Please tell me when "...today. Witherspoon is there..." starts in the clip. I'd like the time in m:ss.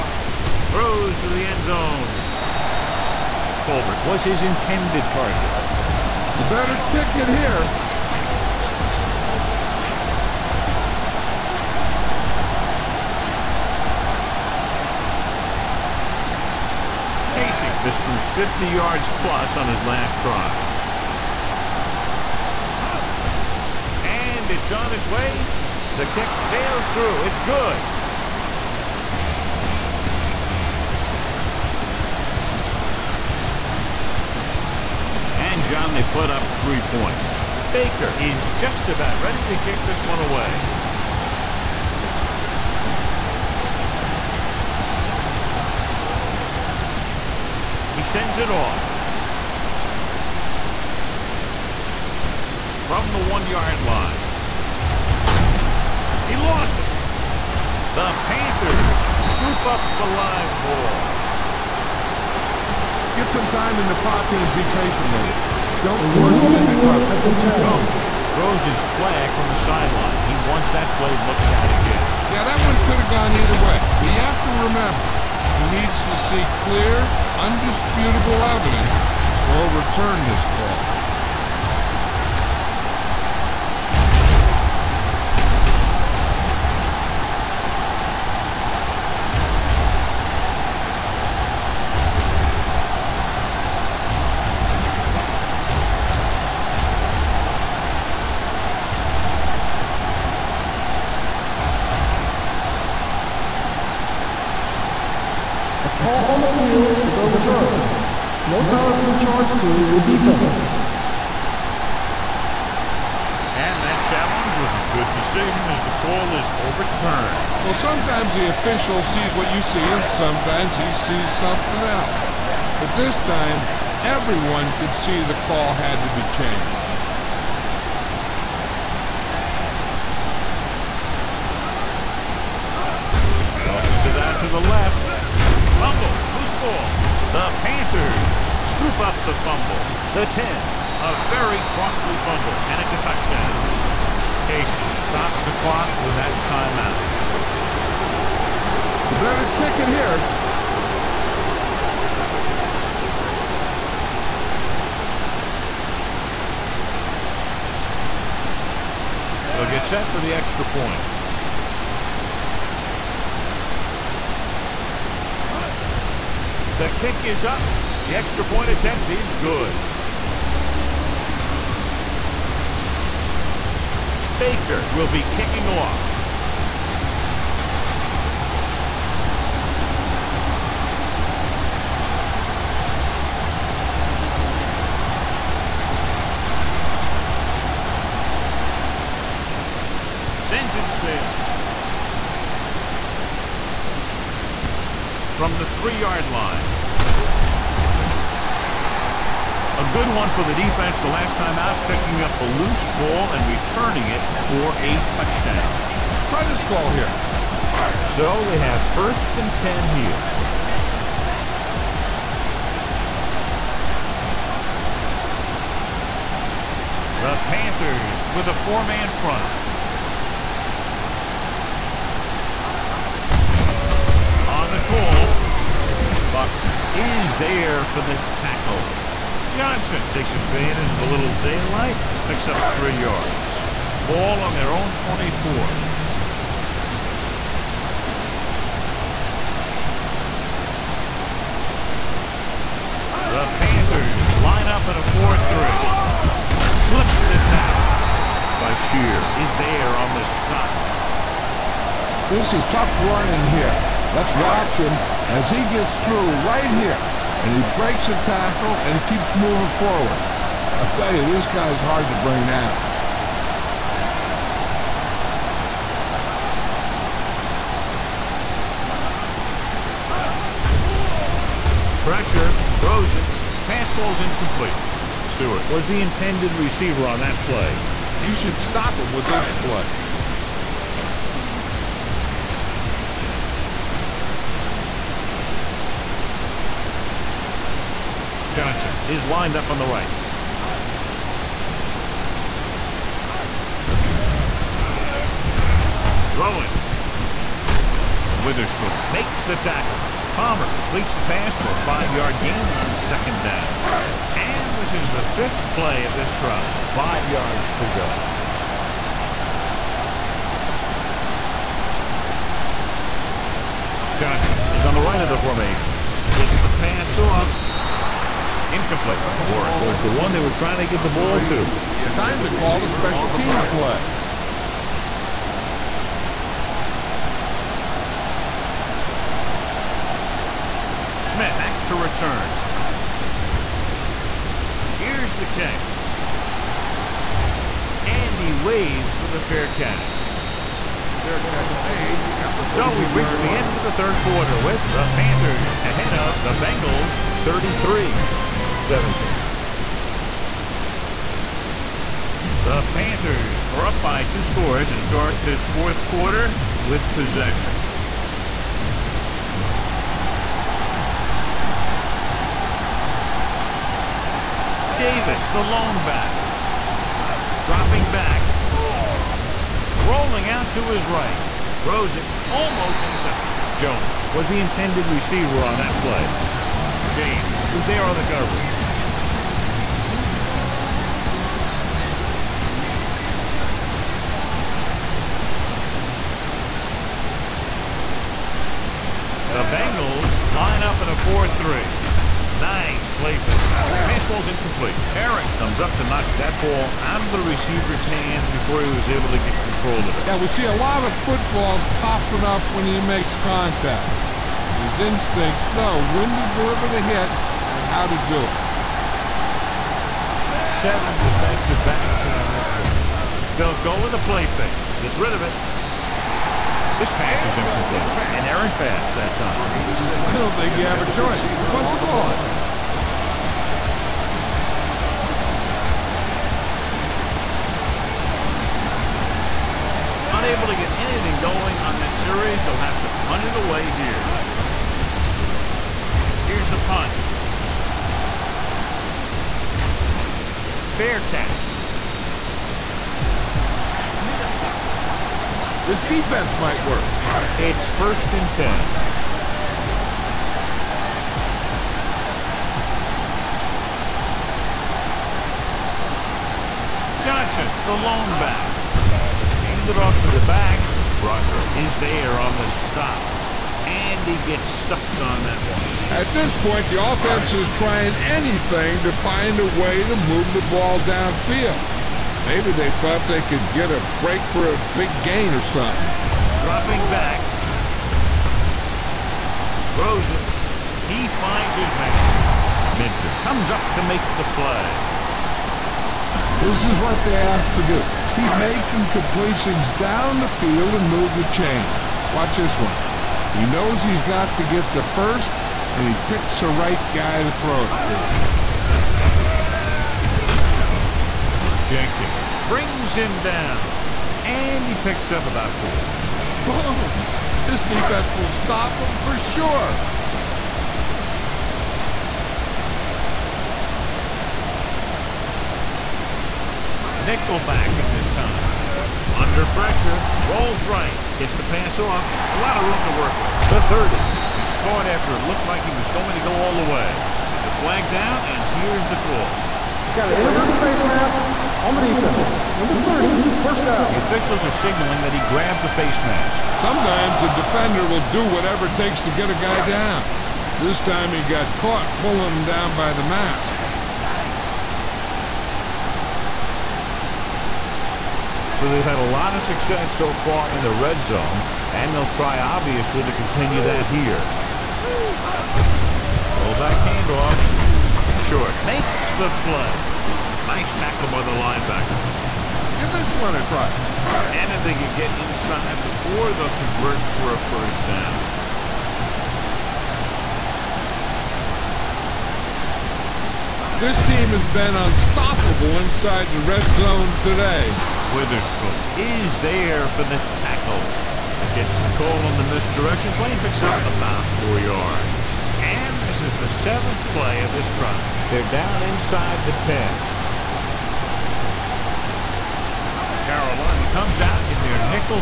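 9:37.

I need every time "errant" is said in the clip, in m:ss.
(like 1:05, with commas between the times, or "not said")
6:58.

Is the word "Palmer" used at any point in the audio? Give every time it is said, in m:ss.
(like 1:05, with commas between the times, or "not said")
5:00.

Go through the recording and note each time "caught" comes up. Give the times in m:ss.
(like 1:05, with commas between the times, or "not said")
8:44, 9:01.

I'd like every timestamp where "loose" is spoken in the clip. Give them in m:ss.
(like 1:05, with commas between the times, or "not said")
2:16, 3:22.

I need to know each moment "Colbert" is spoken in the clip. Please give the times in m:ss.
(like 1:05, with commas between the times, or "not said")
0:03.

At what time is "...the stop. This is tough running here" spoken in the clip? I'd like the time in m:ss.
4:10.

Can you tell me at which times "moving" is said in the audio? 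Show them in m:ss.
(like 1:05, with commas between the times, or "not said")
4:19.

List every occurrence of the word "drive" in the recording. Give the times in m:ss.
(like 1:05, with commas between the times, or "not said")
5:06, 9:48.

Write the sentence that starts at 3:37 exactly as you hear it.
The Panthers with a four-man front.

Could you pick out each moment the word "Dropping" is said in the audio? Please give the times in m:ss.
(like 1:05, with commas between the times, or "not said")
6:07, 7:56.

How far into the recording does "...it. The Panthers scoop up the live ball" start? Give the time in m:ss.
0:56.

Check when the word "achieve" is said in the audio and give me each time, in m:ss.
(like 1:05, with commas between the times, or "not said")
not said.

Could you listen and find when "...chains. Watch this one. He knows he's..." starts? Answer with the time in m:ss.
8:11.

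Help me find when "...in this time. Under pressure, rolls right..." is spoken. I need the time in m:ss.
8:38.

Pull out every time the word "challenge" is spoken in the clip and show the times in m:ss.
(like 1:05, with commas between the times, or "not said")
1:54.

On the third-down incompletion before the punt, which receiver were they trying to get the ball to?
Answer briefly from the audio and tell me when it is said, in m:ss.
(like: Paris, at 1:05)
Warwick, at 5:19.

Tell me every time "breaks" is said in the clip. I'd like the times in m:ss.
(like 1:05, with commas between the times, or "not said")
4:17, 7:54.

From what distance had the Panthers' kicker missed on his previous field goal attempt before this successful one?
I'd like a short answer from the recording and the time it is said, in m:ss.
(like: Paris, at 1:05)
50 yards plus, at 0:18.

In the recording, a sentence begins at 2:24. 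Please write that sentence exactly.
Casey stops the clock with that timeout.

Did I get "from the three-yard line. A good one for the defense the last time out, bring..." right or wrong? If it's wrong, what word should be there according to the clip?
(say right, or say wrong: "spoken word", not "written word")
wrong: "picking", not "bring".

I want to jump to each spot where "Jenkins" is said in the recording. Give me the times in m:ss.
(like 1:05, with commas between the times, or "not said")
8:21.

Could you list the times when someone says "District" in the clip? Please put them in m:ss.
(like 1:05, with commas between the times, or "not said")
not said.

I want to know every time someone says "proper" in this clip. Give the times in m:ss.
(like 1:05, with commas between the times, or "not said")
not said.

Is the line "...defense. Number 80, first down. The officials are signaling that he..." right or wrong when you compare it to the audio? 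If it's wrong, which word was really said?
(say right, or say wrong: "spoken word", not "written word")
wrong: "30", not "80".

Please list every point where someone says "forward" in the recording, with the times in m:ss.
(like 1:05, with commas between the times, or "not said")
4:19.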